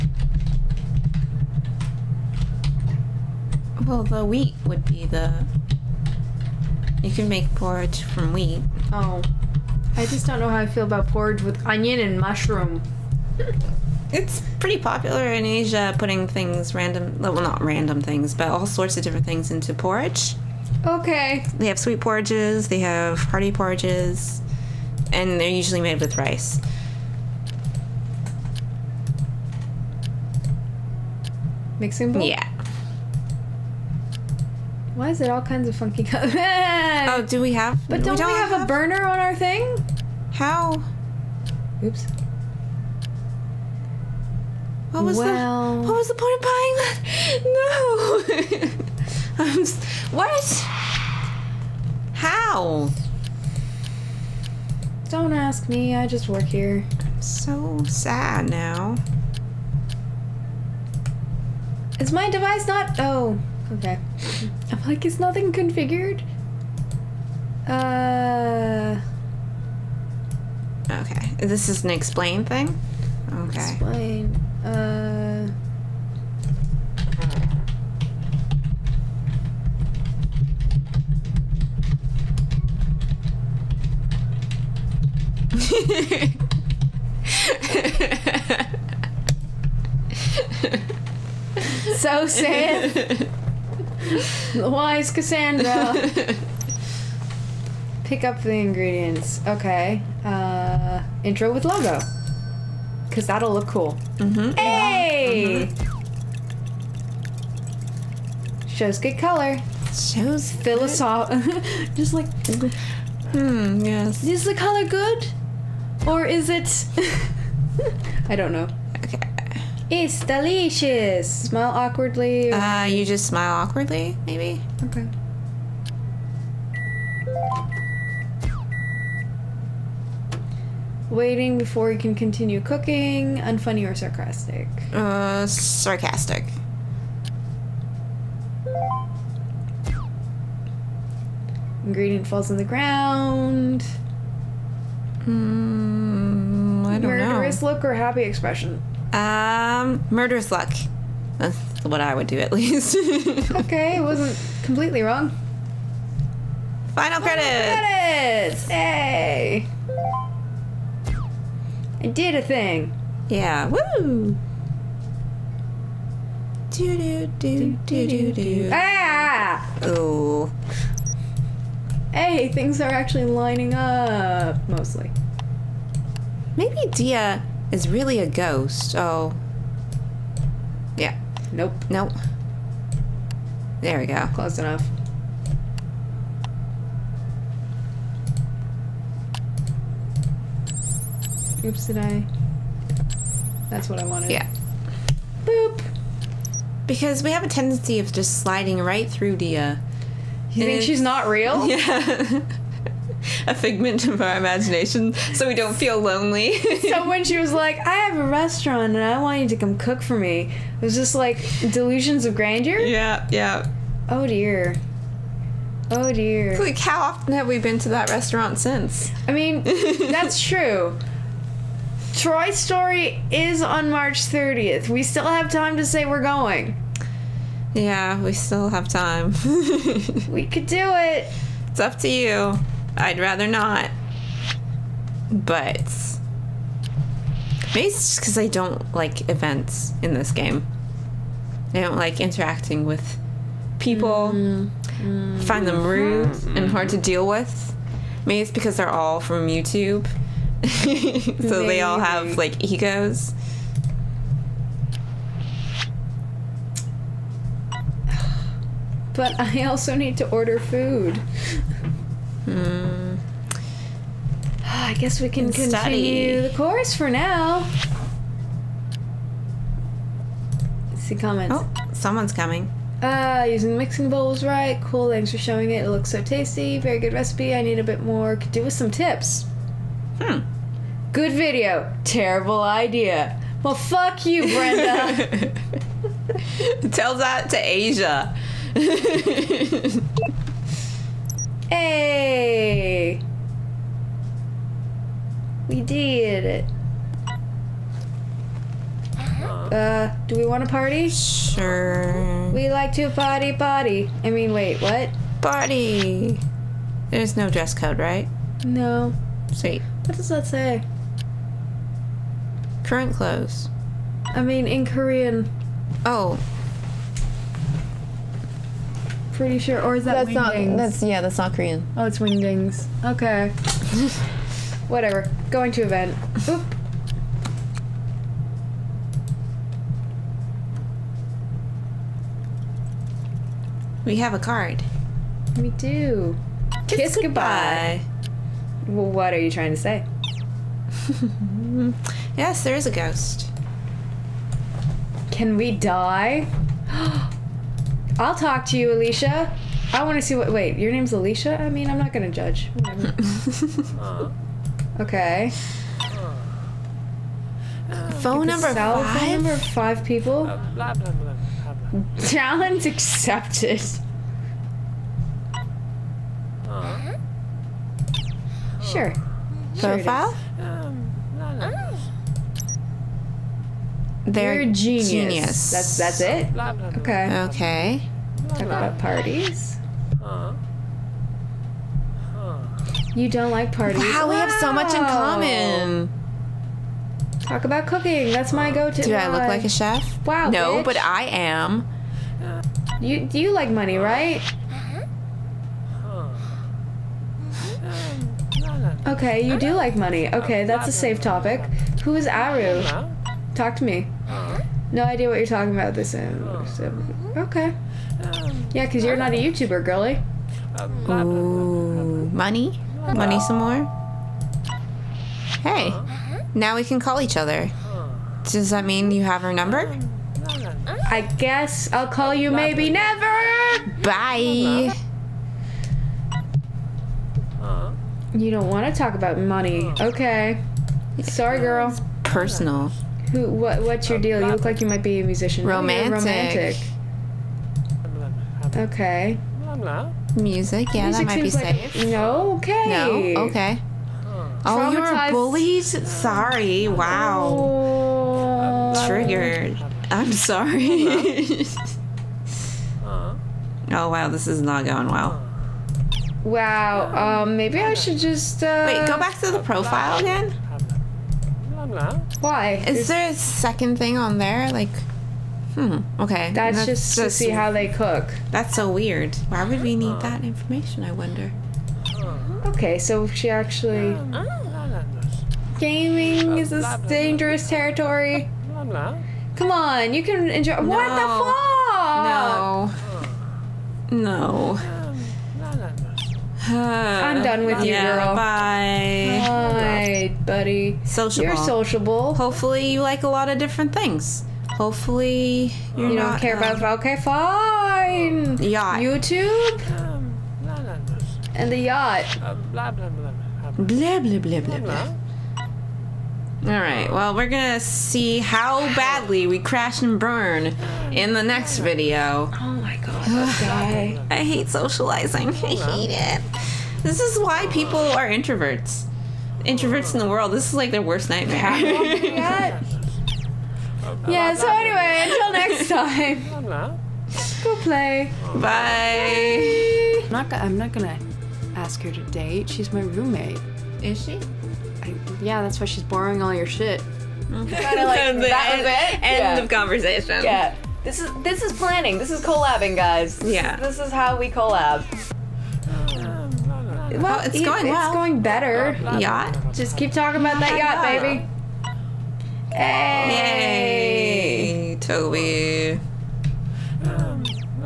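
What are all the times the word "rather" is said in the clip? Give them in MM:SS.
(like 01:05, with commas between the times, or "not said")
03:53.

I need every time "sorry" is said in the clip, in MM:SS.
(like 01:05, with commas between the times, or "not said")
07:11, 07:25, 07:30.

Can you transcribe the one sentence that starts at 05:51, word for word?
I mean, I'm not going to judge.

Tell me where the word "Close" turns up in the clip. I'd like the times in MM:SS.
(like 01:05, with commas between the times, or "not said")
03:04.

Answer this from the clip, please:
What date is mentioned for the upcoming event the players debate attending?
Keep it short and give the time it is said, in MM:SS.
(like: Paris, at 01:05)
March 30th, at 03:43.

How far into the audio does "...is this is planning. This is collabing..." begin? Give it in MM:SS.
09:01.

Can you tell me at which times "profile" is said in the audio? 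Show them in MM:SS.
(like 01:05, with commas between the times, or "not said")
06:09, 07:39.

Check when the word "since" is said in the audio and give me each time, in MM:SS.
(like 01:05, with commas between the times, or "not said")
03:38.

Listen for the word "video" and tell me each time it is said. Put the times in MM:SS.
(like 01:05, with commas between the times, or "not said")
04:41, 08:31.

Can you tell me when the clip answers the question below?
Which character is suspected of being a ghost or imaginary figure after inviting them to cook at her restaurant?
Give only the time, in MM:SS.
02:56.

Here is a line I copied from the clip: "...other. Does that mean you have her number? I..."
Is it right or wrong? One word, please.
right.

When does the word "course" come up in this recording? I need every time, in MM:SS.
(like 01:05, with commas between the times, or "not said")
04:26.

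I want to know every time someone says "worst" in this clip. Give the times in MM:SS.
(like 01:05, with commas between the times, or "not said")
08:41.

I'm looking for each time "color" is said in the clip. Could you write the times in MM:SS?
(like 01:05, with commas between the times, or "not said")
00:36, 01:49, 01:54.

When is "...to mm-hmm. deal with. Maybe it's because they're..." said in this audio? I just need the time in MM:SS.
04:06.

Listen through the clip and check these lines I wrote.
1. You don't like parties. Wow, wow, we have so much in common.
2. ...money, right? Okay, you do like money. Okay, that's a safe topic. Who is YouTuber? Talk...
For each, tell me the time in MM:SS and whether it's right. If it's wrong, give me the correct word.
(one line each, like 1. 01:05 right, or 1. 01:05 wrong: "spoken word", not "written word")
1. 06:23 right
2. 06:33 wrong: "Aru", not "YouTuber".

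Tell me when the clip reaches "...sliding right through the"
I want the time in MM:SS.
03:18.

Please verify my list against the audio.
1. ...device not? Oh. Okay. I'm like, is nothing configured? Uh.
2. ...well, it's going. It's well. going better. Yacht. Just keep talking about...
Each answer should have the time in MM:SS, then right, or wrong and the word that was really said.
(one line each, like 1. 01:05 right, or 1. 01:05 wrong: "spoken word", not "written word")
1. 01:02 right
2. 09:07 right.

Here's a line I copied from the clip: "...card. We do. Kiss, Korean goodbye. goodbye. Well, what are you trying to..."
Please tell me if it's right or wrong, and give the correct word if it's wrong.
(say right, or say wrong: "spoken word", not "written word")
wrong: "Kiss", not "Korean".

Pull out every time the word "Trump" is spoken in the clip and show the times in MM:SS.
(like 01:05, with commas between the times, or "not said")
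not said.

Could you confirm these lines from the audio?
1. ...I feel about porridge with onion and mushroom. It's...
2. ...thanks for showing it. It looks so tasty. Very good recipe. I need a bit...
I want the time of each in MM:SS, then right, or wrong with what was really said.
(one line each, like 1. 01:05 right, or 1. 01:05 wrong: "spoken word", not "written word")
1. 00:10 right
2. 04:35 right.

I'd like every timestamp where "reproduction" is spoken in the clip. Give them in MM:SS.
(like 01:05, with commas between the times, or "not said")
not said.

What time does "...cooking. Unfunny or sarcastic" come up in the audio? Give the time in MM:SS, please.
02:12.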